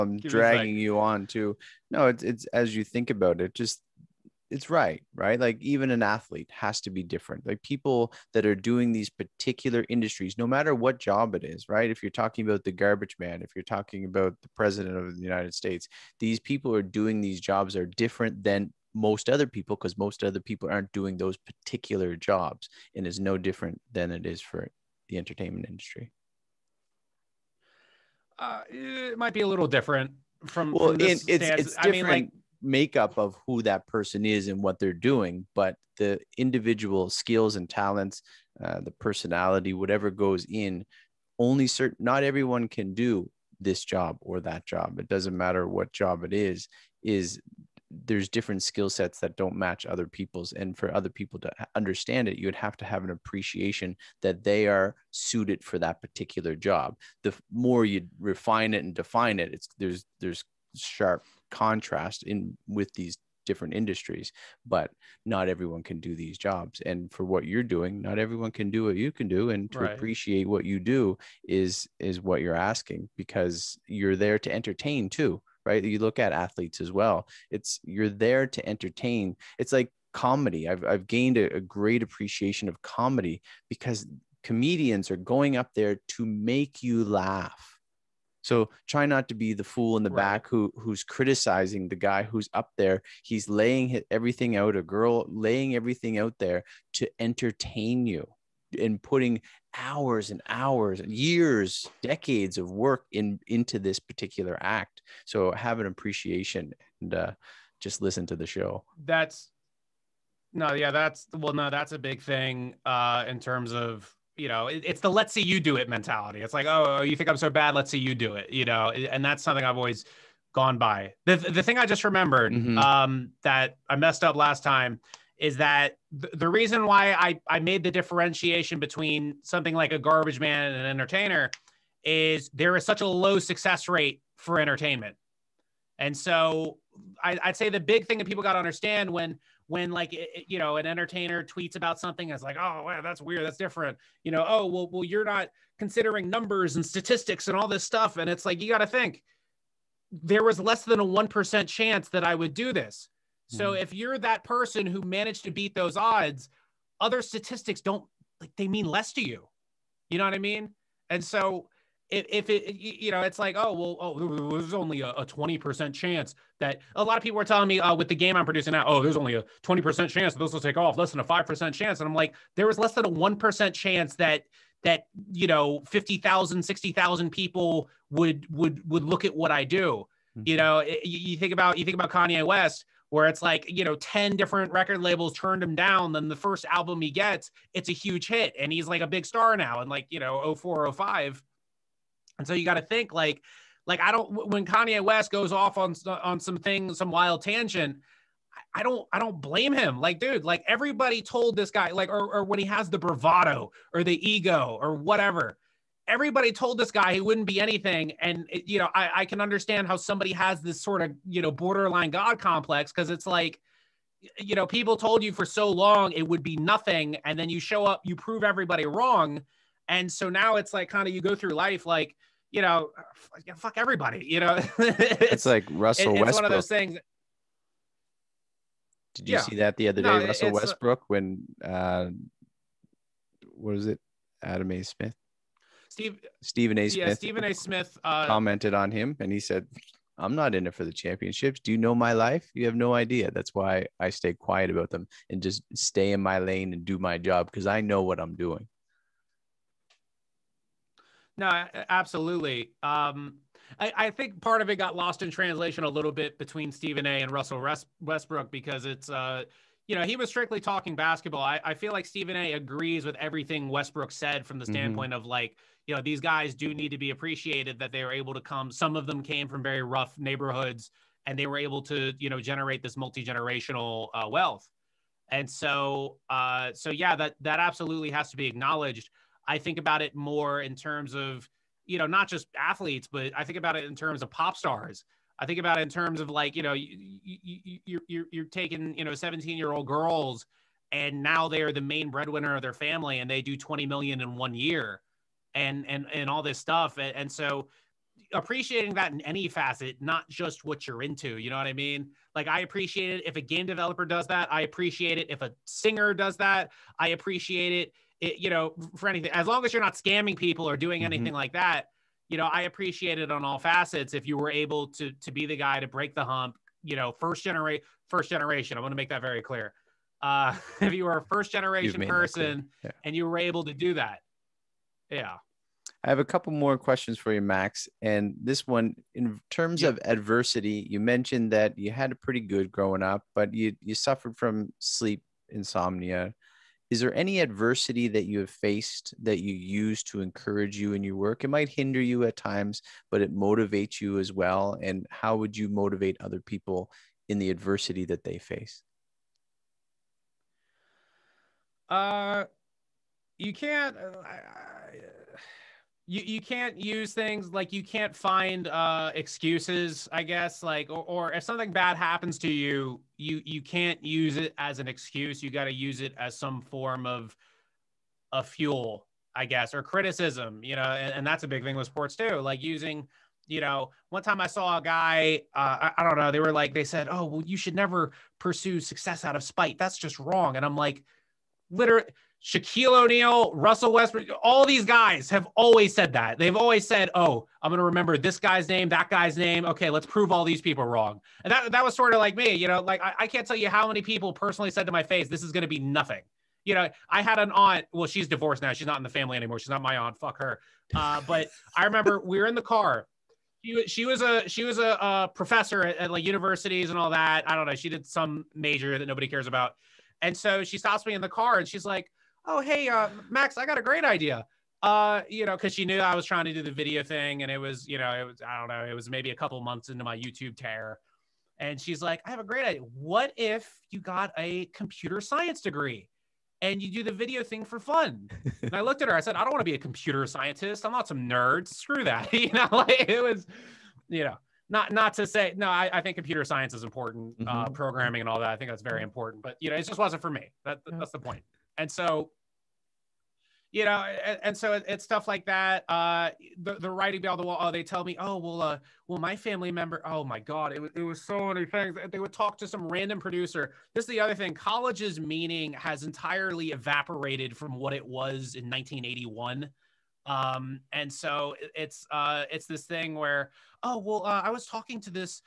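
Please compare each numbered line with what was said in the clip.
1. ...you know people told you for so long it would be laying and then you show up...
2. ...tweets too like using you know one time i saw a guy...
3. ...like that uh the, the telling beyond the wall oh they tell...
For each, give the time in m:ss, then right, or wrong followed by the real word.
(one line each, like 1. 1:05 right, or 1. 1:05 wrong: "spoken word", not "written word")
1. 3:34 wrong: "nothing", not "laying"
2. 6:11 wrong: "sports", not "tweets"
3. 7:25 wrong: "writing", not "telling".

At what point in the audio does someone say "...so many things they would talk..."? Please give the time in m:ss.
7:31.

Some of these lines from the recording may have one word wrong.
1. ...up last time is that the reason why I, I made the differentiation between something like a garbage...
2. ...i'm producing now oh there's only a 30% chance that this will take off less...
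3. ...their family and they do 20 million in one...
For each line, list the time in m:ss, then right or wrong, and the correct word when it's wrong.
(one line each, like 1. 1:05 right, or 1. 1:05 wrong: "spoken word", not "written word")
1. 2:04 right
2. 2:48 wrong: "20", not "30"
3. 4:52 right.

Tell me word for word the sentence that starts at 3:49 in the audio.
see that the other day no, russell uh westbrook when uh what was it adam a smith Steve Stephen A.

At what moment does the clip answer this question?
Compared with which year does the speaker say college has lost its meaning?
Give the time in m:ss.
7:38.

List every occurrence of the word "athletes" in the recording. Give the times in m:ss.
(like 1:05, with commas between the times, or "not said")
0:06, 1:16, 4:42.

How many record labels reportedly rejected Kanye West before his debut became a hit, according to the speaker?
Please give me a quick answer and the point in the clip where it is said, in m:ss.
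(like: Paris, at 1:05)
10, at 3:03.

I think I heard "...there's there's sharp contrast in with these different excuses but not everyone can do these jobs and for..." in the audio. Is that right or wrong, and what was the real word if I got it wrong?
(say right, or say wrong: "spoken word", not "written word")
wrong: "industries", not "excuses".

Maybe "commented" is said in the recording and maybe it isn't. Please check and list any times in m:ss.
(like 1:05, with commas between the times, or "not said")
3:58.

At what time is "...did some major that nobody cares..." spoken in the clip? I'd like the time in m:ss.
6:47.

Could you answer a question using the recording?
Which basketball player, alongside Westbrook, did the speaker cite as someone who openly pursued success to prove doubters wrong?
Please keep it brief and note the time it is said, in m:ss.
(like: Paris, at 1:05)
Shaquille O'Neal, at 6:22.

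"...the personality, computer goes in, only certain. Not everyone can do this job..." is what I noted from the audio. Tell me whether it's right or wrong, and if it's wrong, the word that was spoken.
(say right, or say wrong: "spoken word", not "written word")
wrong: "whatever", not "computer".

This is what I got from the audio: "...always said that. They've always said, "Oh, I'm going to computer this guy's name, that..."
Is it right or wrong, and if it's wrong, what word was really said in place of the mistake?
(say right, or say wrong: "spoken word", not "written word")
wrong: "remember", not "computer".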